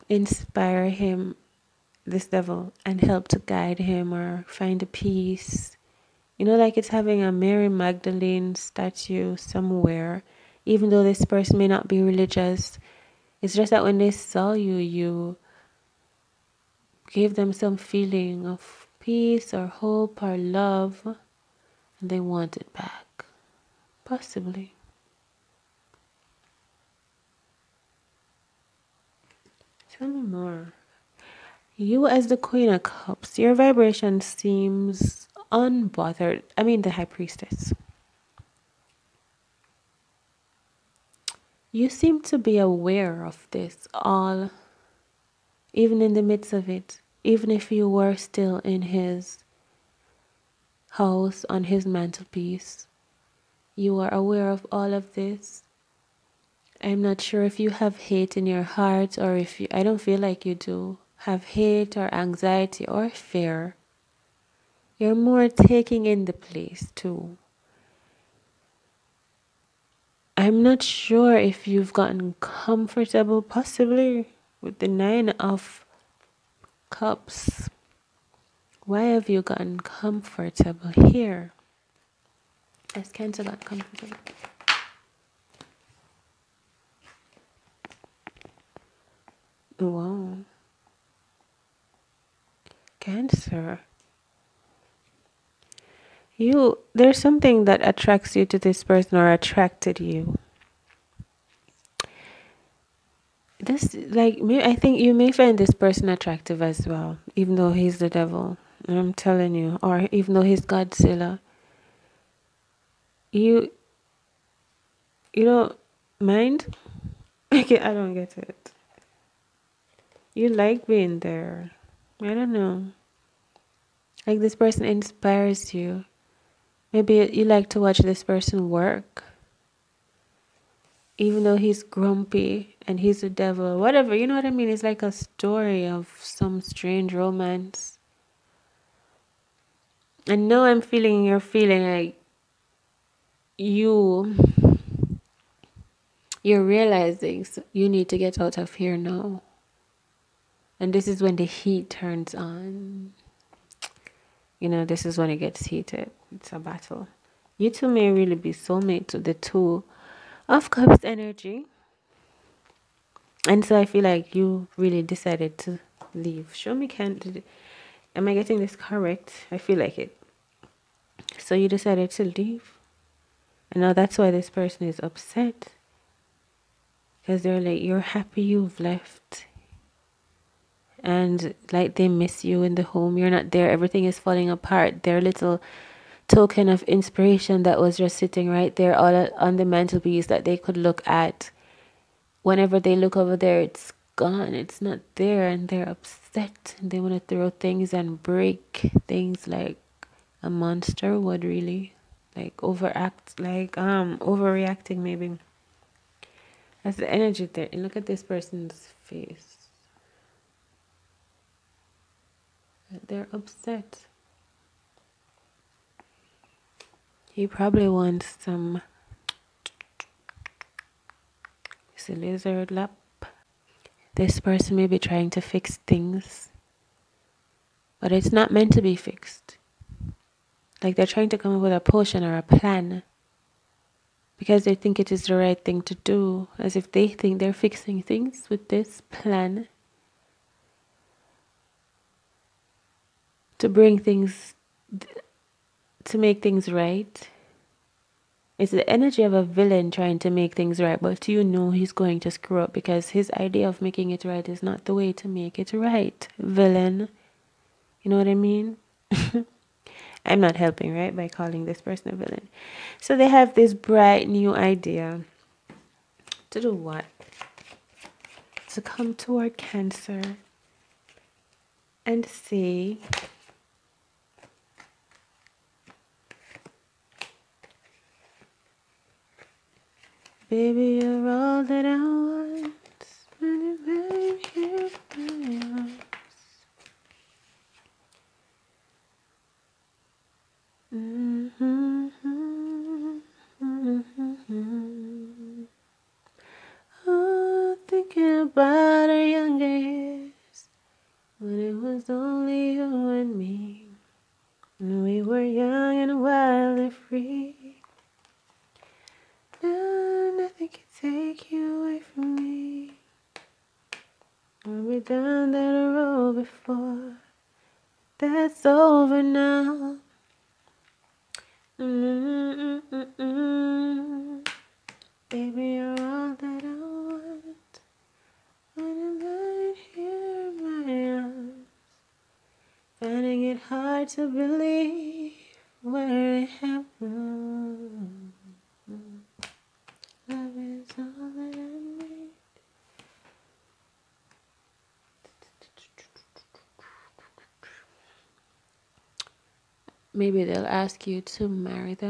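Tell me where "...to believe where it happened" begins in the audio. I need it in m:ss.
5:34.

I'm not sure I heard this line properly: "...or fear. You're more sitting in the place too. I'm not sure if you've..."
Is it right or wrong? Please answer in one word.
wrong.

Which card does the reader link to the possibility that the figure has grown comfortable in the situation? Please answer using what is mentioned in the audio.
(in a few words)
Nine of Cups.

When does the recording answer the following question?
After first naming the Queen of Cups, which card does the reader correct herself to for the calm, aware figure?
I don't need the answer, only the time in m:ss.
0:36.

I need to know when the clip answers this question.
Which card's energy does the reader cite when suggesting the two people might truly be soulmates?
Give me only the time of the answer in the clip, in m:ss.
2:39.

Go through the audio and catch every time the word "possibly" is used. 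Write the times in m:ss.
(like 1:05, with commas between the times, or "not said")
0:24, 1:13.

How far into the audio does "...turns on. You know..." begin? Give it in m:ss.
2:31.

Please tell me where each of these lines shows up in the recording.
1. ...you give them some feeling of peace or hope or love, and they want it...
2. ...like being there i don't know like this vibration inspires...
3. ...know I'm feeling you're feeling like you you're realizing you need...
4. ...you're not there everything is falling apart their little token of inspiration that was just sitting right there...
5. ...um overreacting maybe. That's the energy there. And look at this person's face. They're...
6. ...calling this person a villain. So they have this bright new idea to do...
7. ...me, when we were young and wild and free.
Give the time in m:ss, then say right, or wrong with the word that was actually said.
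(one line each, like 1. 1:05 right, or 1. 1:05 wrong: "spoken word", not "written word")
1. 0:14 right
2. 2:00 wrong: "person", not "vibration"
3. 2:20 right
4. 3:03 right
5. 3:23 right
6. 4:21 right
7. 5:03 right.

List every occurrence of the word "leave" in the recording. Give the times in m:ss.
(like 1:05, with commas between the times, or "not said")
2:46, 2:52.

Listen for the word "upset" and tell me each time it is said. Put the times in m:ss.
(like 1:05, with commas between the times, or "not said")
2:55, 3:15, 3:33.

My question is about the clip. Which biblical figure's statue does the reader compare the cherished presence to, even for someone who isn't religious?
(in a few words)
Mary Magdalene.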